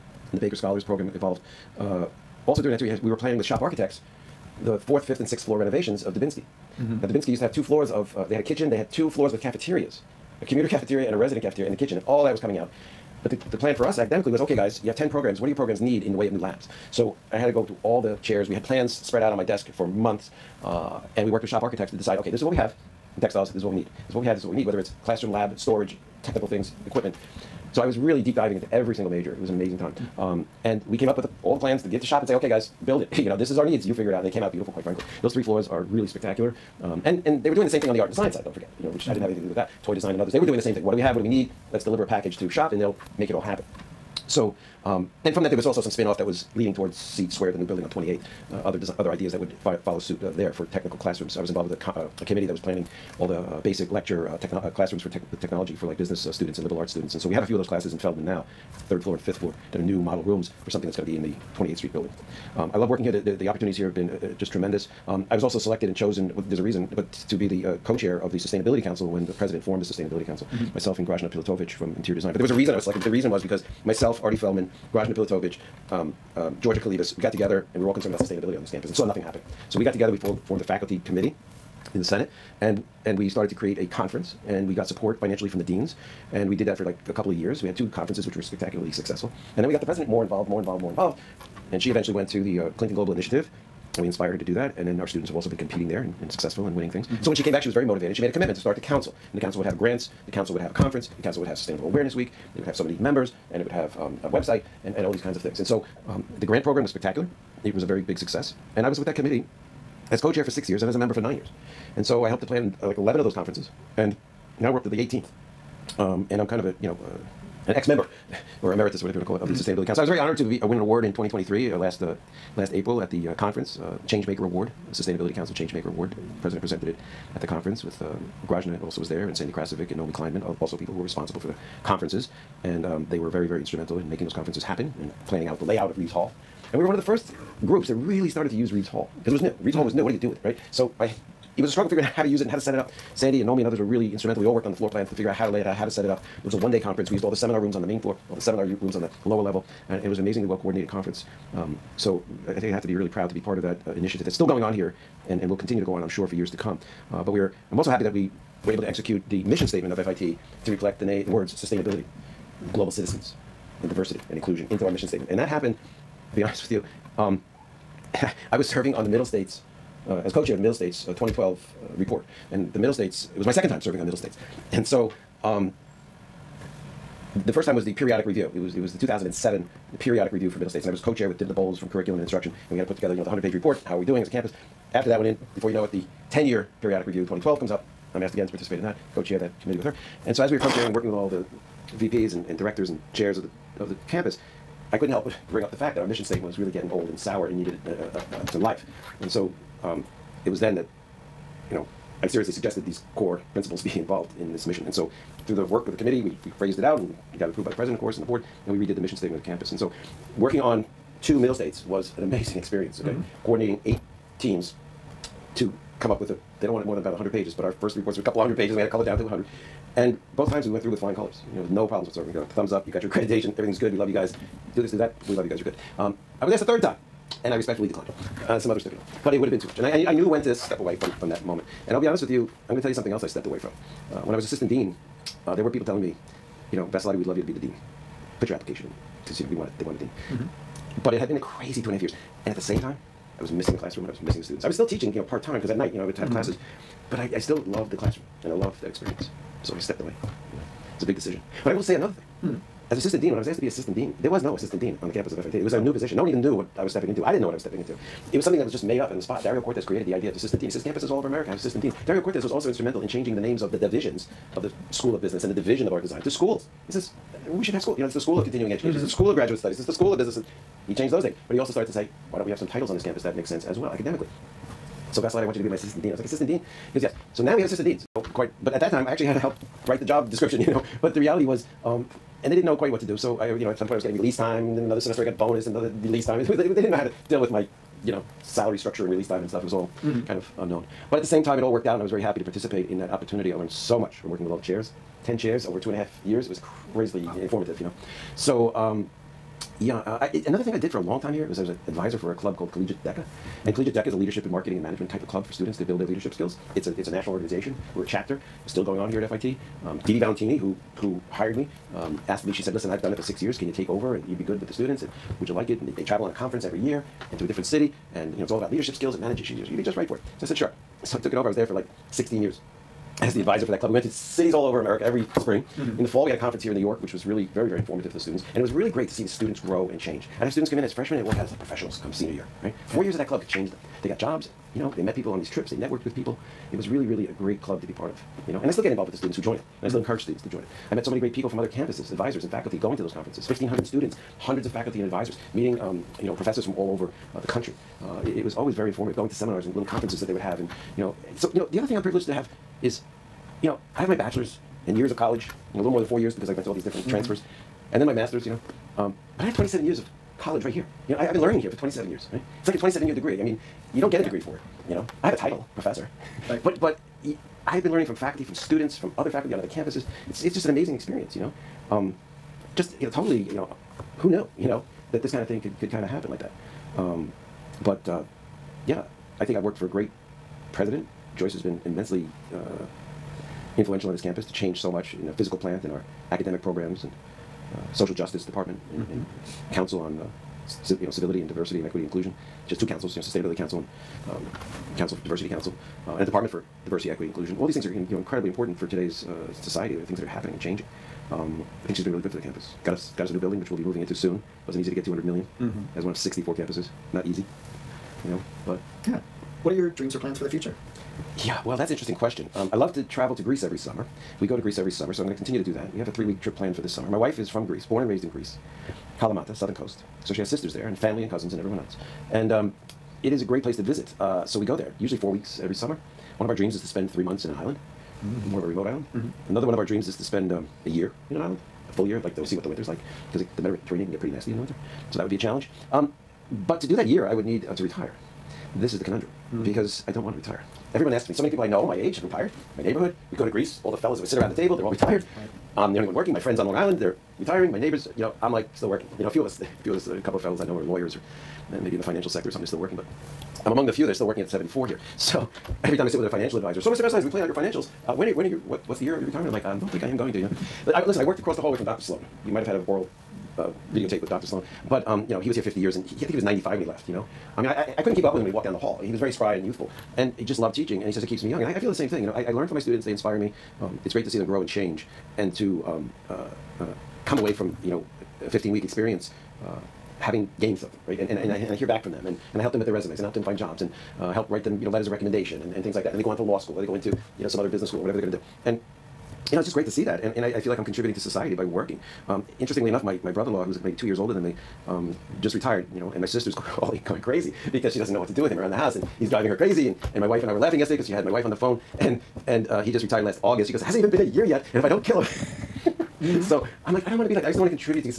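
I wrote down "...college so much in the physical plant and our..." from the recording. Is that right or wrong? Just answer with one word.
wrong.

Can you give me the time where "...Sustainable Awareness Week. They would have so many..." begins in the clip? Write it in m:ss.
1:41.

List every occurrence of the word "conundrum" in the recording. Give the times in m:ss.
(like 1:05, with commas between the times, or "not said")
7:19.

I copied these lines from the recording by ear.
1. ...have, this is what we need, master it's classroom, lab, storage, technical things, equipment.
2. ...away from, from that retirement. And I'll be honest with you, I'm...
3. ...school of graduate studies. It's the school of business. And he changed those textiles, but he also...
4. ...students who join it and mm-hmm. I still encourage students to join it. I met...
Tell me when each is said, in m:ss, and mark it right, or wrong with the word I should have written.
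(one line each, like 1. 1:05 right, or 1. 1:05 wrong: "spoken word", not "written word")
1. 0:24 wrong: "whether", not "master"
2. 3:50 wrong: "moment", not "retirement"
3. 4:29 wrong: "names", not "textiles"
4. 5:39 right.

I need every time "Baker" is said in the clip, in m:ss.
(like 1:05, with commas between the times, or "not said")
0:00.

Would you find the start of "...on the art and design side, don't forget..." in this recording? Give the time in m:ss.
0:37.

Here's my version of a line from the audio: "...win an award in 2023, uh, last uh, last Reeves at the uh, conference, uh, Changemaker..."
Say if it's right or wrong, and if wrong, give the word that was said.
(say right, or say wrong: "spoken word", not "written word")
wrong: "April", not "Reeves".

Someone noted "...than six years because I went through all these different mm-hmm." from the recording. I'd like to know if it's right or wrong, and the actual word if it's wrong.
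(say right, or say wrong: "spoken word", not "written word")
wrong: "four", not "six".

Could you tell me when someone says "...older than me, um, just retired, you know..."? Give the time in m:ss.
8:14.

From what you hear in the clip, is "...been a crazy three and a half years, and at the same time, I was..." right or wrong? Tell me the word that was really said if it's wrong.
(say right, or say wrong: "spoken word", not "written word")
wrong: "two", not "three".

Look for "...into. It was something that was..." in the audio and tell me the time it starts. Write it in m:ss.
4:17.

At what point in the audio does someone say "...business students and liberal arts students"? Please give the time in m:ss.
0:55.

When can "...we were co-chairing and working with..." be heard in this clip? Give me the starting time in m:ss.
3:10.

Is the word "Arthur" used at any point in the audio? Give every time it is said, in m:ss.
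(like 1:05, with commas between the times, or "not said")
not said.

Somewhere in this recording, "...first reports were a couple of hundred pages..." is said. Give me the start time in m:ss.
3:37.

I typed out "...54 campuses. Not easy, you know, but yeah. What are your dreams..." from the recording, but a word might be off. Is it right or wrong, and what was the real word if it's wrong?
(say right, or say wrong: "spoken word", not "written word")
wrong: "64", not "54".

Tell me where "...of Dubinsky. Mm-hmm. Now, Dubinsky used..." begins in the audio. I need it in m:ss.
0:06.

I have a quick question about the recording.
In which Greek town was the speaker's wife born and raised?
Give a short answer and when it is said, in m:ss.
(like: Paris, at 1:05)
Kalamata, at 6:59.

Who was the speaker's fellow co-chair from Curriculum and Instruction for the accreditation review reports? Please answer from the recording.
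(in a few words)
Dimna Bowles.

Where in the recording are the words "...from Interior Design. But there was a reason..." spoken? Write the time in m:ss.
1:11.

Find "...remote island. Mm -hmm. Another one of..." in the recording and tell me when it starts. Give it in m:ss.
7:08.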